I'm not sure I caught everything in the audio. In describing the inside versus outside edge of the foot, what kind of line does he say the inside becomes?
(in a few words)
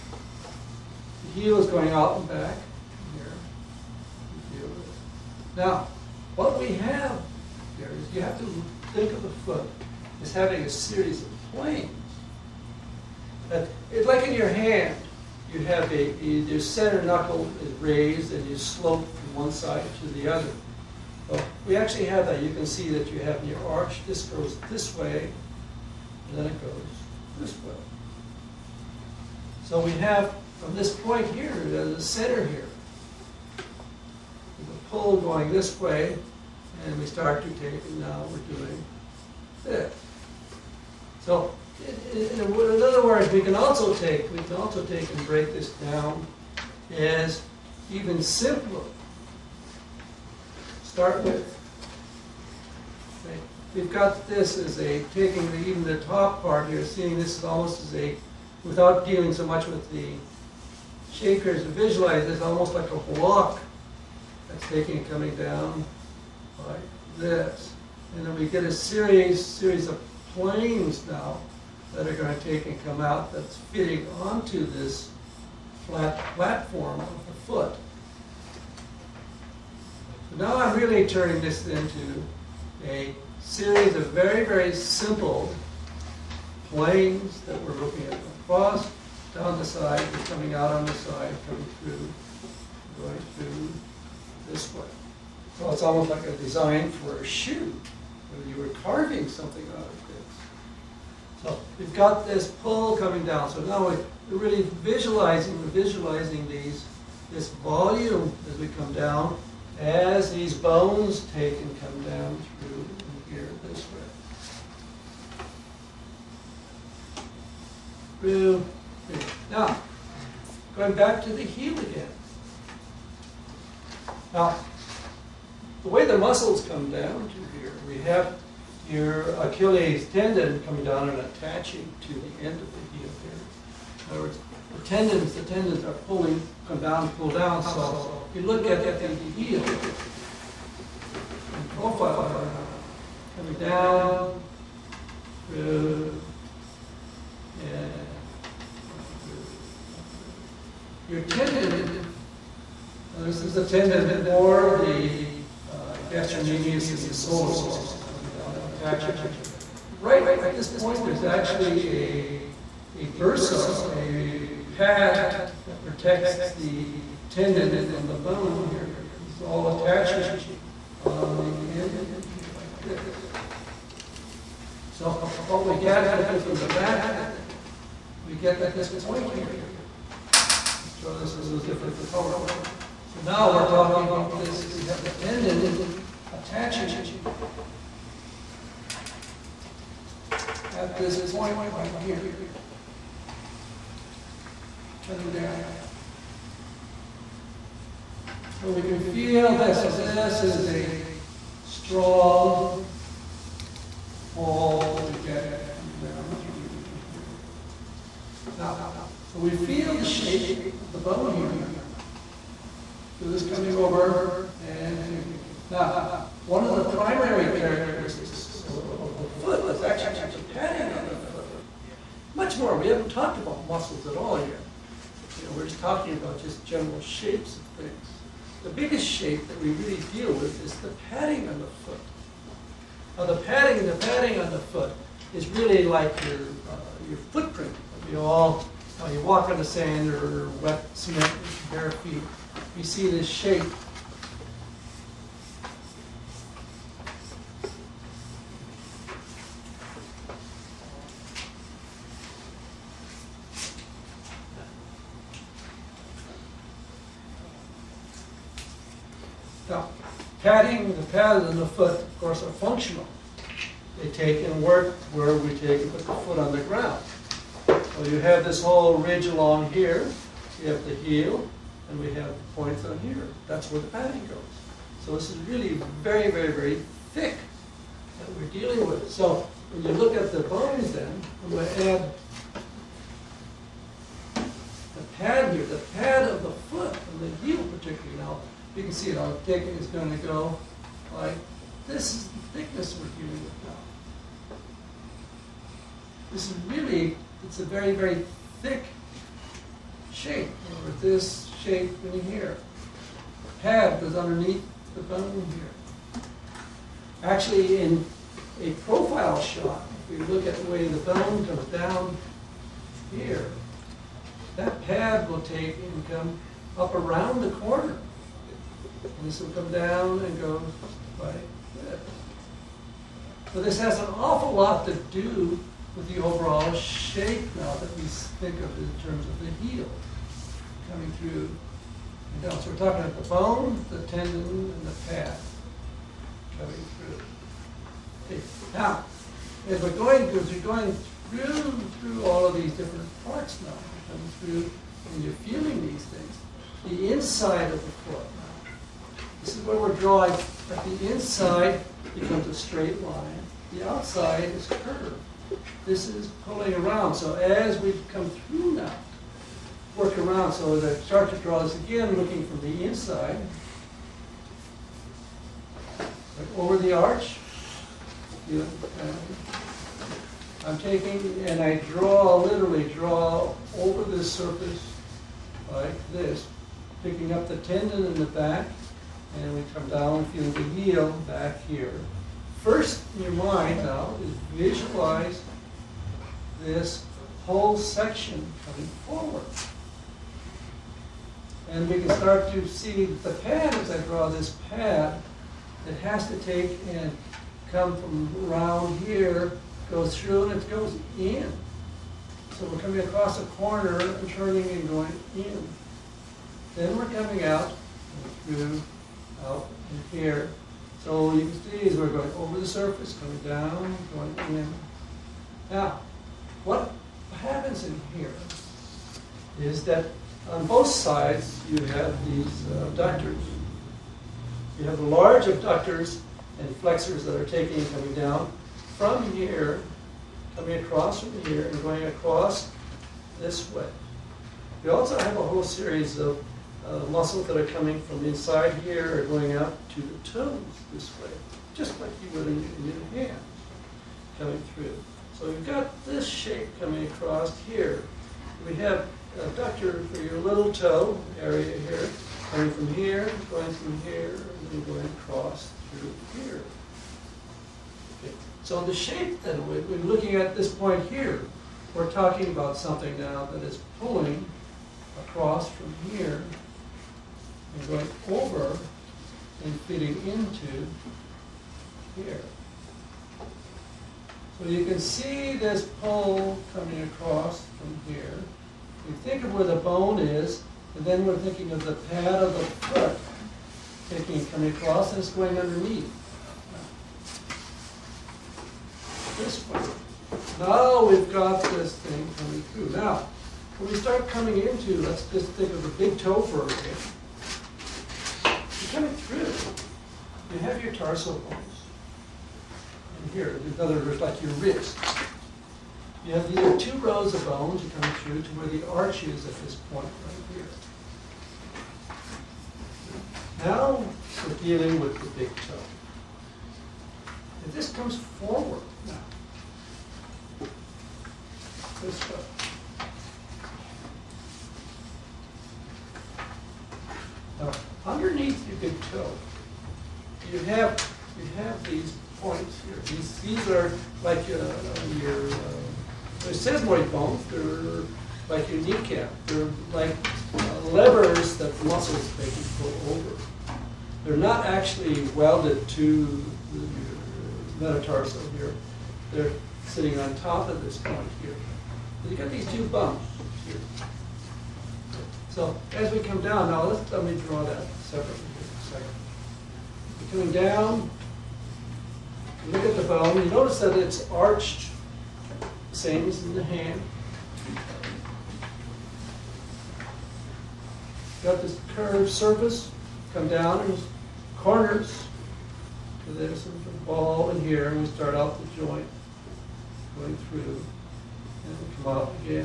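A straight line.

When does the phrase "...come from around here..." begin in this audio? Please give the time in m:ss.
6:37.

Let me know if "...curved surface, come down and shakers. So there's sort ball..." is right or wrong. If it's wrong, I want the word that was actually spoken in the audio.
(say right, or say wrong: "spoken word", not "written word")
wrong: "corners", not "shakers".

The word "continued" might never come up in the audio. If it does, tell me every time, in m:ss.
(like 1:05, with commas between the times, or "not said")
not said.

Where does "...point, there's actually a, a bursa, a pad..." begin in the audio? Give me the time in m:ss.
2:40.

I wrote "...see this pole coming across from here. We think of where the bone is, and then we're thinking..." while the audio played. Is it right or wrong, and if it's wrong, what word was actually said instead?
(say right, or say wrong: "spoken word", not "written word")
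right.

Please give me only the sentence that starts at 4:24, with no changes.
They take and work where we take and put the foot on the ground.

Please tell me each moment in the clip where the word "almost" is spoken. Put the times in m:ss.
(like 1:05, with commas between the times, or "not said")
0:57, 1:02, 1:35.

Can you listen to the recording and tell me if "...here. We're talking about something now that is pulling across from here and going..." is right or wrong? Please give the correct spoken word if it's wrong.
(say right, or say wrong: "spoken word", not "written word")
right.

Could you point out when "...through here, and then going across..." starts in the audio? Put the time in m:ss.
7:33.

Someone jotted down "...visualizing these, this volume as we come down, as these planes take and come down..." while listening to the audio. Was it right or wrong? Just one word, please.
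wrong.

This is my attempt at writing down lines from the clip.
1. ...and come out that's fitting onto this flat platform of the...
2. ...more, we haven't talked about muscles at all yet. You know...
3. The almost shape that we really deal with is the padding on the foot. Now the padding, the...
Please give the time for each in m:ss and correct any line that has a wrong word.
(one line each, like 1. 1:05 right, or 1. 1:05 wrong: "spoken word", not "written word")
1. 1:12 right
2. 3:42 right
3. 3:48 wrong: "biggest", not "almost".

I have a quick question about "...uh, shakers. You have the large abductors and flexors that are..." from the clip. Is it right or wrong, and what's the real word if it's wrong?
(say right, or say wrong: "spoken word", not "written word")
wrong: "abductors", not "shakers".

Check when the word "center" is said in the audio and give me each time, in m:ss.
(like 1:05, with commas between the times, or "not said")
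0:16, 0:31.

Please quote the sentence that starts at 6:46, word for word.
Then we're coming out through out in here.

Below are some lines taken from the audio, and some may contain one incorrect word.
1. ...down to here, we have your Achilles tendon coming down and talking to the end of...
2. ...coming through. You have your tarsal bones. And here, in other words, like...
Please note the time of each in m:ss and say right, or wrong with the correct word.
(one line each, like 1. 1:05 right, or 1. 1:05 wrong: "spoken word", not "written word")
1. 2:06 wrong: "attaching", not "talking"
2. 8:18 right.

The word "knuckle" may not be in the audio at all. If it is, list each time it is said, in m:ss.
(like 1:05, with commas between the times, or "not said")
0:17.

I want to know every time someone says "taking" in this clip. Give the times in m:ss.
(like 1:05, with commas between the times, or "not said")
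0:55, 1:04, 6:10, 7:07, 8:04.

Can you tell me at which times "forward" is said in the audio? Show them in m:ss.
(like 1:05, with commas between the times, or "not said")
6:29, 8:38.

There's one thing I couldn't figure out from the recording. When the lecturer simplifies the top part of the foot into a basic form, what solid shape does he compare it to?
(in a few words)
A block.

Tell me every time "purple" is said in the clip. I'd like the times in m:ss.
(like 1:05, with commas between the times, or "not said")
not said.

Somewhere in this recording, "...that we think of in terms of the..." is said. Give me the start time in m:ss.
5:27.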